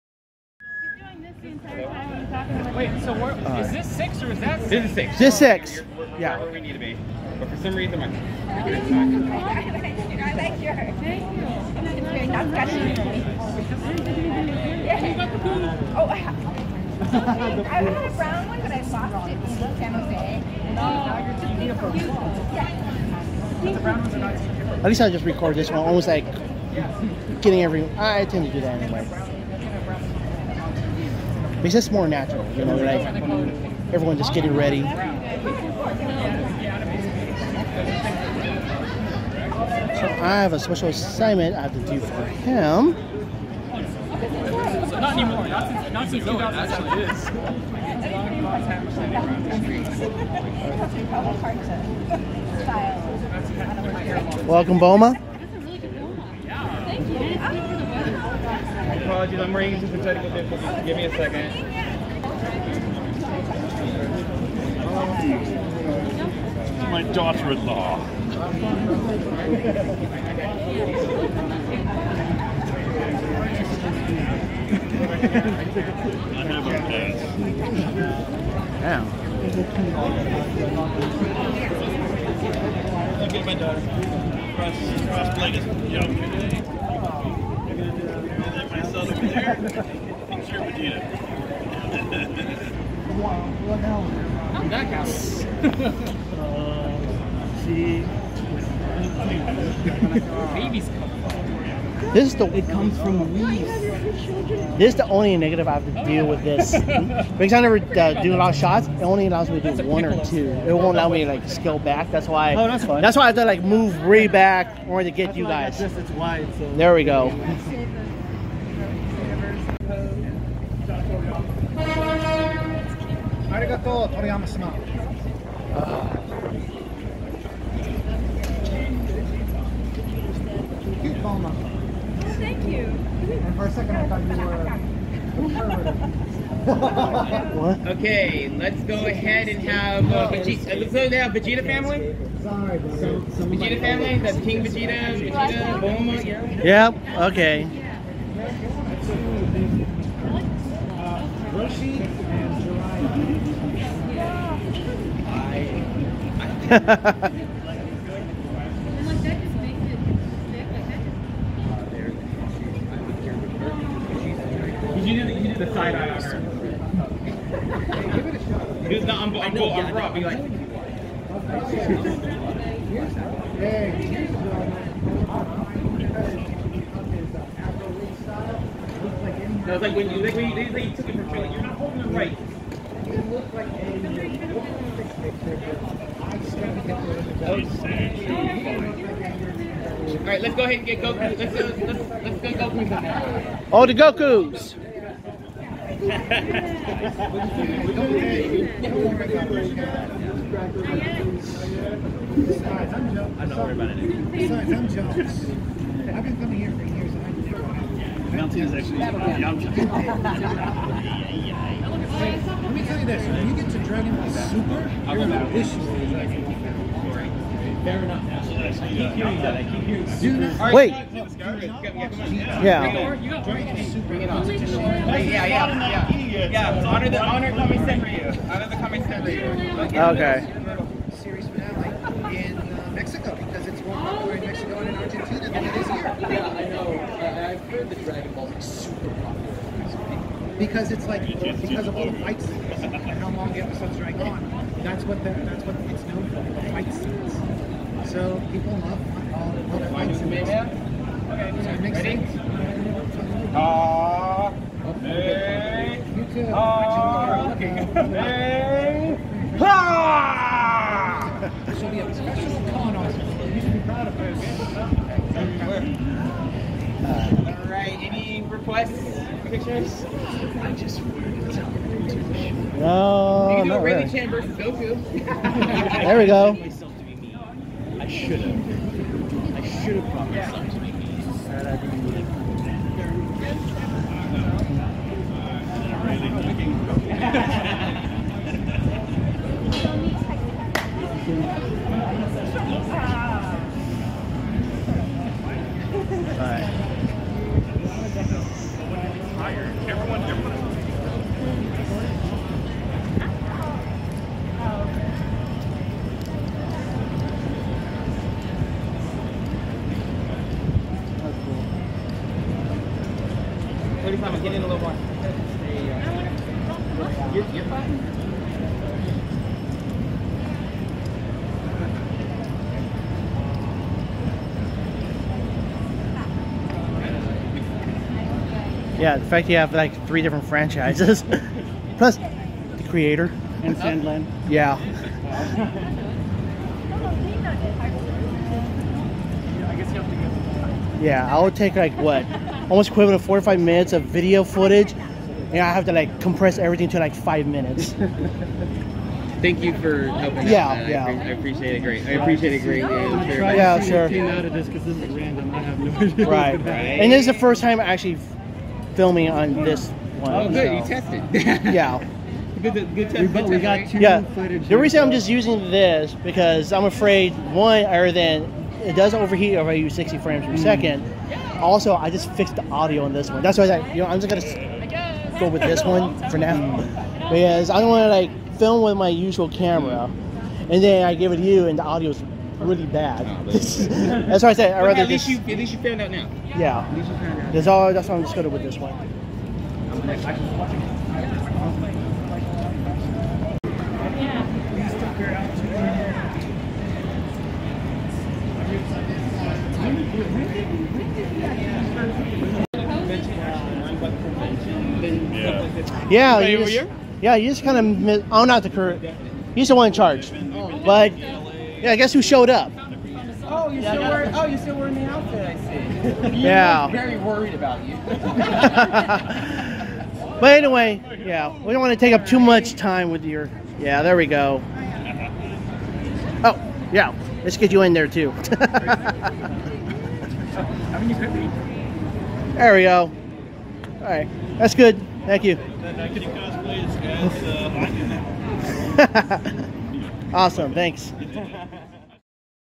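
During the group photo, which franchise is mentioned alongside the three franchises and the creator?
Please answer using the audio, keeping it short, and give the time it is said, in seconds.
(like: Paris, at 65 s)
Sand Land, at 333 s.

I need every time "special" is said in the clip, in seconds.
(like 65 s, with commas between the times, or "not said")
40 s, 262 s.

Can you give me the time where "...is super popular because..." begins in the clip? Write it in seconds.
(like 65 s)
238 s.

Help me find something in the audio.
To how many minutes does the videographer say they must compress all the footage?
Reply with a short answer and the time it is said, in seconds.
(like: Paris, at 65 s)
5, at 347 s.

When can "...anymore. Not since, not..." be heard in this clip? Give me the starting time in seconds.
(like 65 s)
45 s.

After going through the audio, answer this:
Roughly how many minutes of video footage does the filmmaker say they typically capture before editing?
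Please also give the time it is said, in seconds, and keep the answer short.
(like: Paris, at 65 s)
45, at 343 s.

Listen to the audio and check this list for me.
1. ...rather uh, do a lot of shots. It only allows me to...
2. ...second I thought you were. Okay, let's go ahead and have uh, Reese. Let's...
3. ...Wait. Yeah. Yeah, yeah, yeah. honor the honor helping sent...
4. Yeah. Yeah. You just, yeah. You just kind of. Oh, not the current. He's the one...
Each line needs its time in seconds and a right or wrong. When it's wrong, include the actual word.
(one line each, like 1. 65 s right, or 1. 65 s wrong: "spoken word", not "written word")
1. 107 s wrong: "never", not "rather"
2. 133 s wrong: "Vegeta", not "Reese"
3. 220 s wrong: "coming", not "helping"
4. 406 s right.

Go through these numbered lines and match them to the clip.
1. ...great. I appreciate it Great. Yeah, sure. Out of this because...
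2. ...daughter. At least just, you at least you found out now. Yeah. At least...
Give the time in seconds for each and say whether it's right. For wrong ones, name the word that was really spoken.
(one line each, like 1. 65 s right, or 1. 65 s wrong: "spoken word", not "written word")
1. 351 s right
2. 384 s wrong: "rather", not "daughter".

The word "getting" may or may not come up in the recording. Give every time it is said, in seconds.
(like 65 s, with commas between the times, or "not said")
27 s, 34 s.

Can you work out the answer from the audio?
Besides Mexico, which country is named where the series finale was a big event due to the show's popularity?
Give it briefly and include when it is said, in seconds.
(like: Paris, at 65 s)
Argentina, at 234 s.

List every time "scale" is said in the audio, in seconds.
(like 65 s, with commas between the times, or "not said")
111 s.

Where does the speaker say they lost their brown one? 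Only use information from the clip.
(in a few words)
San Jose.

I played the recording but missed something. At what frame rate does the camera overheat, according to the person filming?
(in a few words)
60 frames per second.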